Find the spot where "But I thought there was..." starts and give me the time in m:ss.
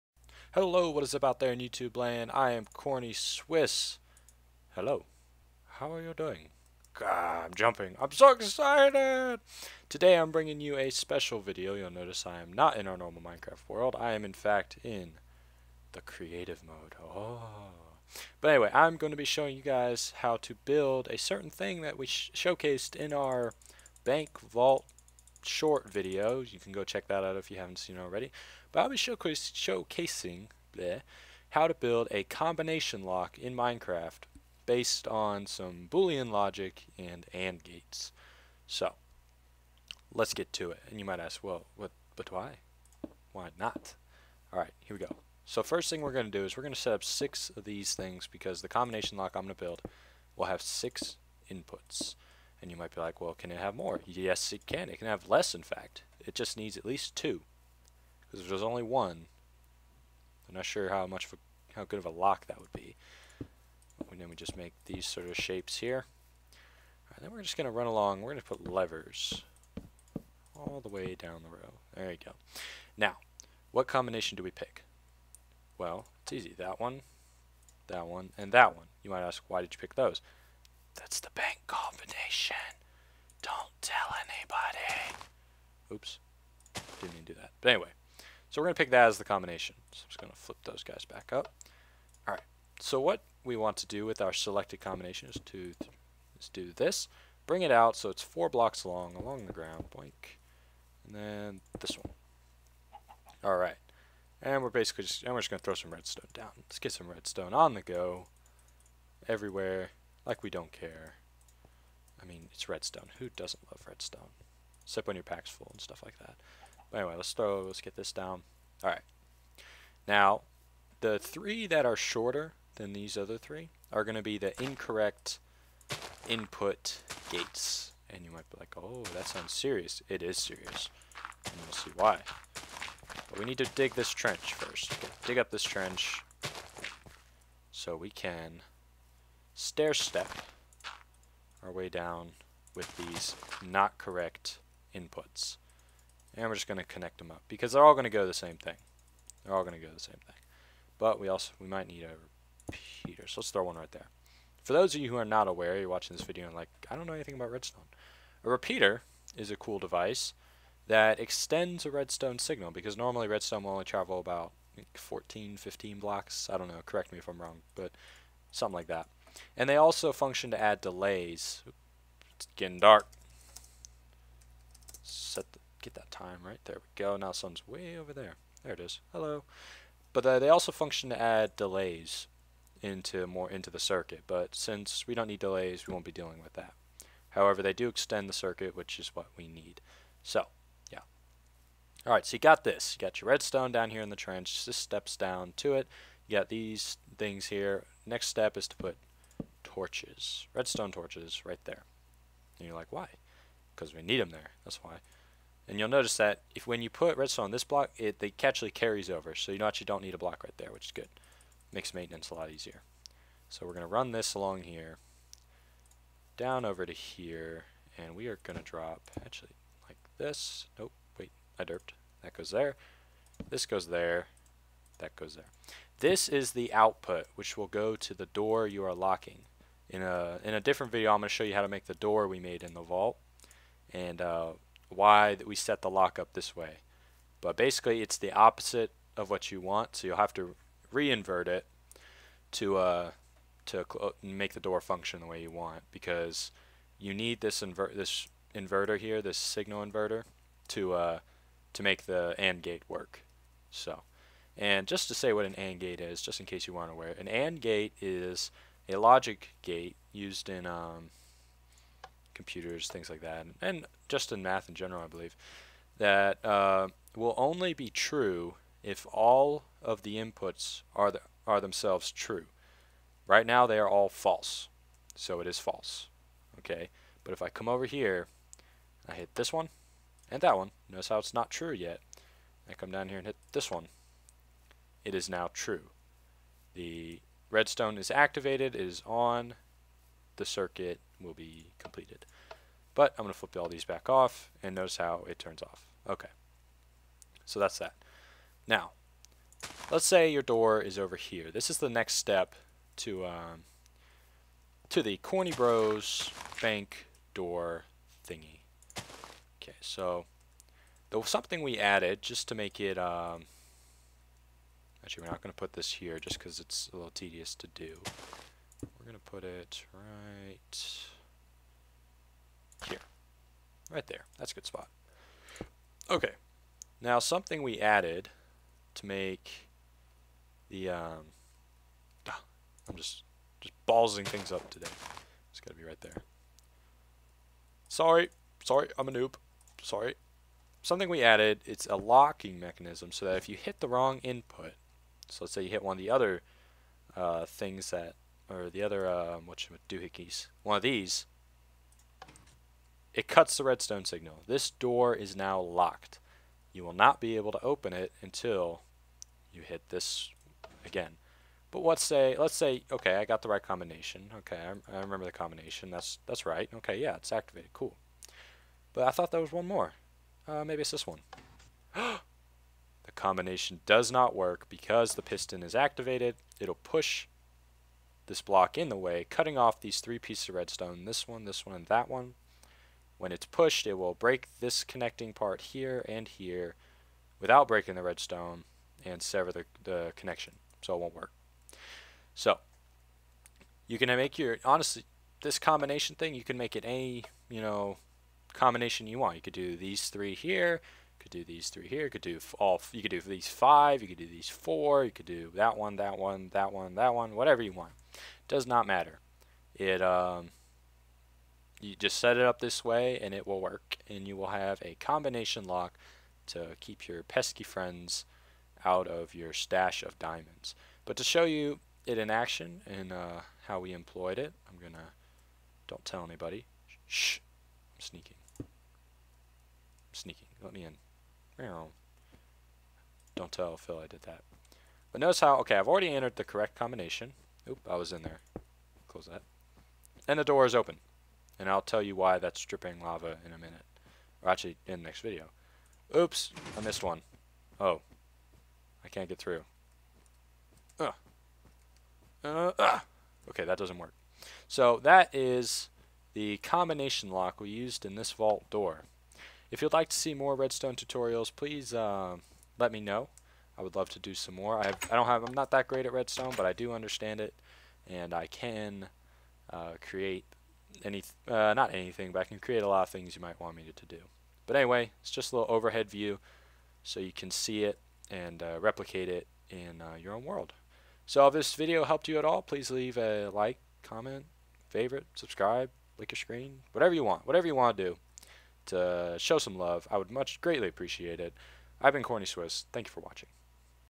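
6:08.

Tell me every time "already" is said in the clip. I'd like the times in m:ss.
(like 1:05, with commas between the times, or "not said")
0:27, 7:15.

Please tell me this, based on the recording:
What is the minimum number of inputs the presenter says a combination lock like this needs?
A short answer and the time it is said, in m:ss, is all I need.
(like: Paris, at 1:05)
2, at 0:56.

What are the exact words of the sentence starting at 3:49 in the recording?
In a, in a different video, I'm going to show you how to make the door we made in the vault.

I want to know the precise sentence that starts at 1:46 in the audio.
Let's get some redstone on the go.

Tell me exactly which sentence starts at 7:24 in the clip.
Or actually, in the next video.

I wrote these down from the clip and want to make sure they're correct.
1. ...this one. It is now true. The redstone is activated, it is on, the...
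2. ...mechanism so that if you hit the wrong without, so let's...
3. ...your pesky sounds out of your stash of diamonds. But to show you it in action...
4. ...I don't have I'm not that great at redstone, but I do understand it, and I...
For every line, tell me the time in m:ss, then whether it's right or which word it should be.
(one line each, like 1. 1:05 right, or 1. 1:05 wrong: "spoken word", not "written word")
1. 4:43 right
2. 5:42 wrong: "input", not "without"
3. 6:57 wrong: "friends", not "sounds"
4. 7:45 right.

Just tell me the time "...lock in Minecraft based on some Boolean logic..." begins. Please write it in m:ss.
0:33.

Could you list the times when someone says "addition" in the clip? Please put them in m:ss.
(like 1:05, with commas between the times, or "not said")
not said.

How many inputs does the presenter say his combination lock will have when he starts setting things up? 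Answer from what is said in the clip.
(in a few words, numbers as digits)
6.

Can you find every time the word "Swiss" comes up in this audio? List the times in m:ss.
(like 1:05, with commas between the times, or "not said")
0:03, 8:12.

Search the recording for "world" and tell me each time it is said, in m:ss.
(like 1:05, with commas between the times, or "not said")
0:13, 8:00.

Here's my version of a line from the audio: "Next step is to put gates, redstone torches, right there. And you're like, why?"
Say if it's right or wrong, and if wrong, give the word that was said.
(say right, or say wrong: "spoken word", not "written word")
wrong: "torches", not "gates".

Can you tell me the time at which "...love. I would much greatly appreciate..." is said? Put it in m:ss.
8:09.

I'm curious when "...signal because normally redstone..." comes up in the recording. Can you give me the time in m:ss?
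2:42.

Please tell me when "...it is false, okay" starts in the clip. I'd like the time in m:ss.
4:35.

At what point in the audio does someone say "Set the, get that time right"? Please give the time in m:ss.
2:55.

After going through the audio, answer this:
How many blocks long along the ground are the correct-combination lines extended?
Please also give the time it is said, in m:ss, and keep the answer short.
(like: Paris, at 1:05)
4, at 1:38.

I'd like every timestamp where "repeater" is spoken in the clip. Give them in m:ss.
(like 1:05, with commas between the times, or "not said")
2:33, 2:38.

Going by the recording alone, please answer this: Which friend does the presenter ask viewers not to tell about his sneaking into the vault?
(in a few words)
Phil.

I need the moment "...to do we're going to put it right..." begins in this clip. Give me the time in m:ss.
5:17.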